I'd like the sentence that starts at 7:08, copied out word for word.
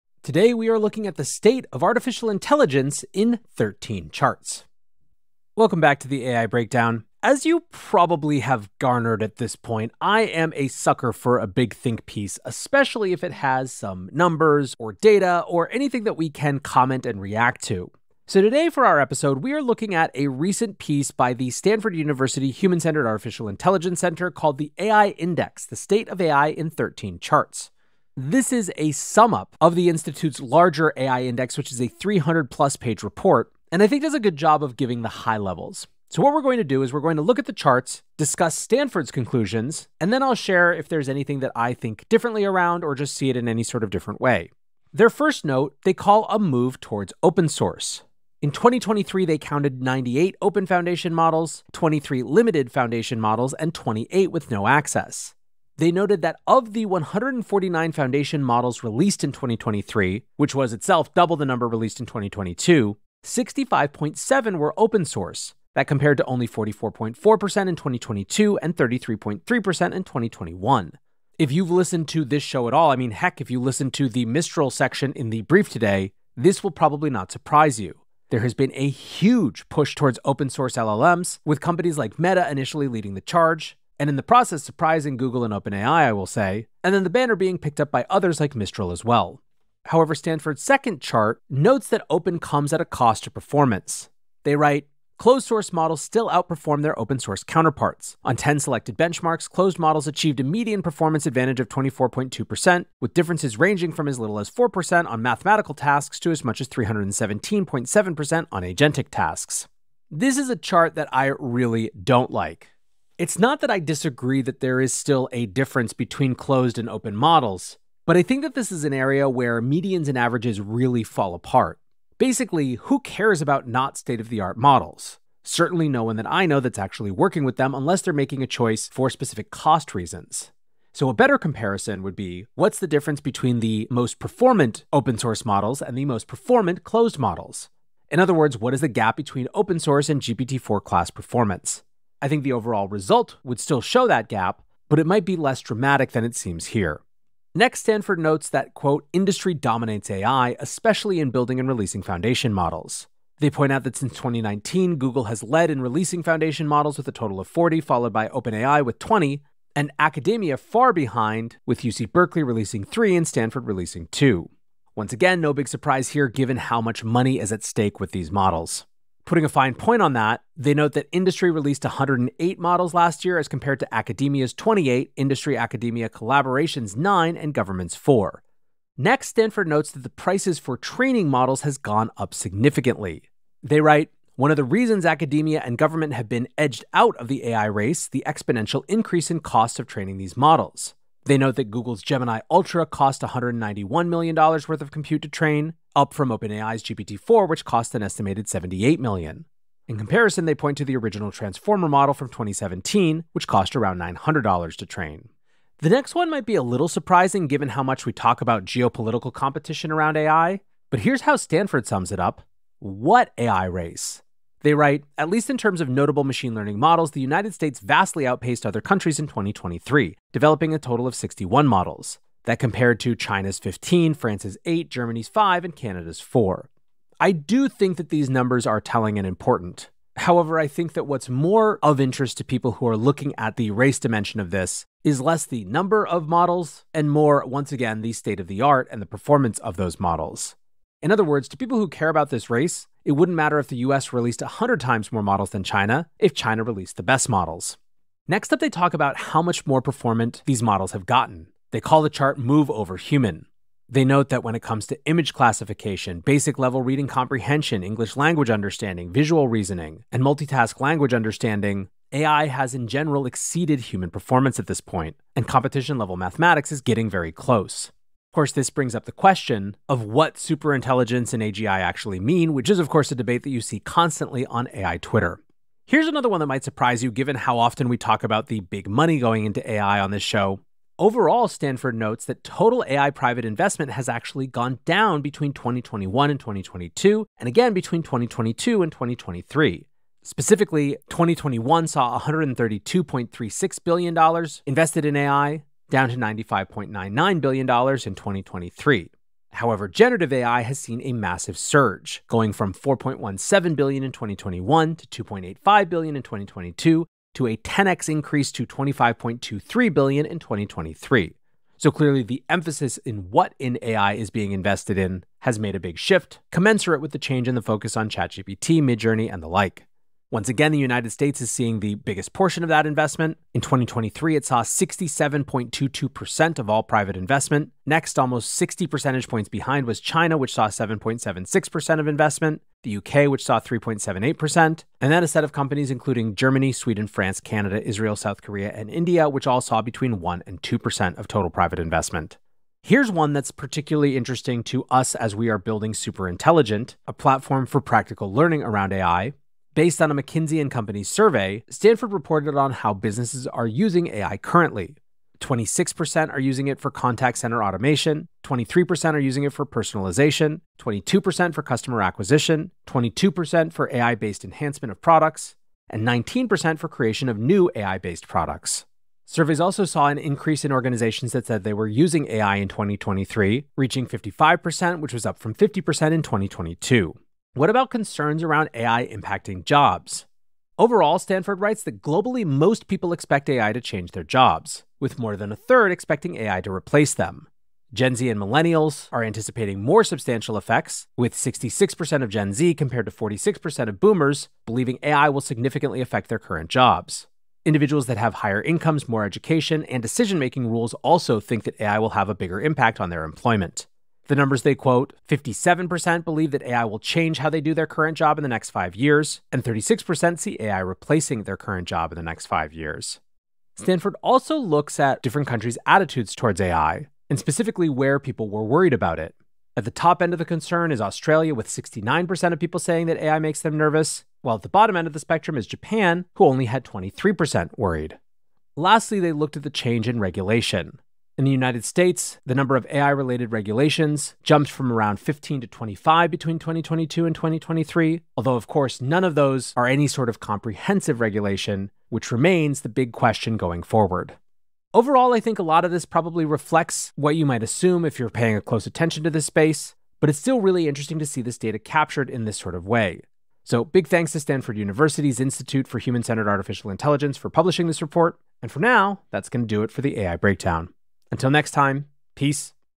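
Lastly, they looked at the change in regulation.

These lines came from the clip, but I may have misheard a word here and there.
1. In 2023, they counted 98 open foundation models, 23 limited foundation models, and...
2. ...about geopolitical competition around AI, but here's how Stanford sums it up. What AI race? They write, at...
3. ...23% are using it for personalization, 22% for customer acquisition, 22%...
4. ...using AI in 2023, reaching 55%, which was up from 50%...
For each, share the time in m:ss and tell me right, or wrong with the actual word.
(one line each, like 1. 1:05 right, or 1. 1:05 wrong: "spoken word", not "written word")
1. 0:48 right
2. 3:28 right
3. 5:58 right
4. 6:11 right.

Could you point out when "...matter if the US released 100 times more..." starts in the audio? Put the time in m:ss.
4:03.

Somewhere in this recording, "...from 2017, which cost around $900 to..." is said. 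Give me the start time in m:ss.
3:22.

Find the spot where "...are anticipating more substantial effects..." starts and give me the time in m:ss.
6:29.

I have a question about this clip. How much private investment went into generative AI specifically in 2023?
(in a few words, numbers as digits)
$25.23 billion.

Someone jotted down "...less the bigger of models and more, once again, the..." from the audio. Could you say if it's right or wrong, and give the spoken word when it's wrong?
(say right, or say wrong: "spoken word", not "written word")
wrong: "number", not "bigger".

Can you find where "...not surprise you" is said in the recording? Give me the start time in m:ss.
1:17.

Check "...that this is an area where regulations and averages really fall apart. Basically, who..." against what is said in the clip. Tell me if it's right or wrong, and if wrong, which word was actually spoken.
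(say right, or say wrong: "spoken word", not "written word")
wrong: "medians", not "regulations".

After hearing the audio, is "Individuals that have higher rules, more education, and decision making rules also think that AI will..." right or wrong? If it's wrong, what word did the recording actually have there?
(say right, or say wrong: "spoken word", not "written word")
wrong: "incomes", not "rules".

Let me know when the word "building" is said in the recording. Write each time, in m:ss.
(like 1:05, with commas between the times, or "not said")
2:31, 5:45.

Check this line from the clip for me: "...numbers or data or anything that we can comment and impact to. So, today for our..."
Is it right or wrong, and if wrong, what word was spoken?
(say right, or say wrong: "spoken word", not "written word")
wrong: "react", not "impact".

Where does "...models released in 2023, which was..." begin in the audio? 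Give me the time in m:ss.
0:58.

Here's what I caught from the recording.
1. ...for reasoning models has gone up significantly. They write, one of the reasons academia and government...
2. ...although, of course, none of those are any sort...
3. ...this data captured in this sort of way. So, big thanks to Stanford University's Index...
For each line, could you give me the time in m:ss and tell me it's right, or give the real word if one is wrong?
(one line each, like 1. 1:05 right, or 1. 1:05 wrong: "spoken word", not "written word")
1. 3:00 wrong: "training", not "reasoning"
2. 7:18 right
3. 7:31 wrong: "Institute", not "Index".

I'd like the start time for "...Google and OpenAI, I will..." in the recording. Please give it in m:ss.
1:25.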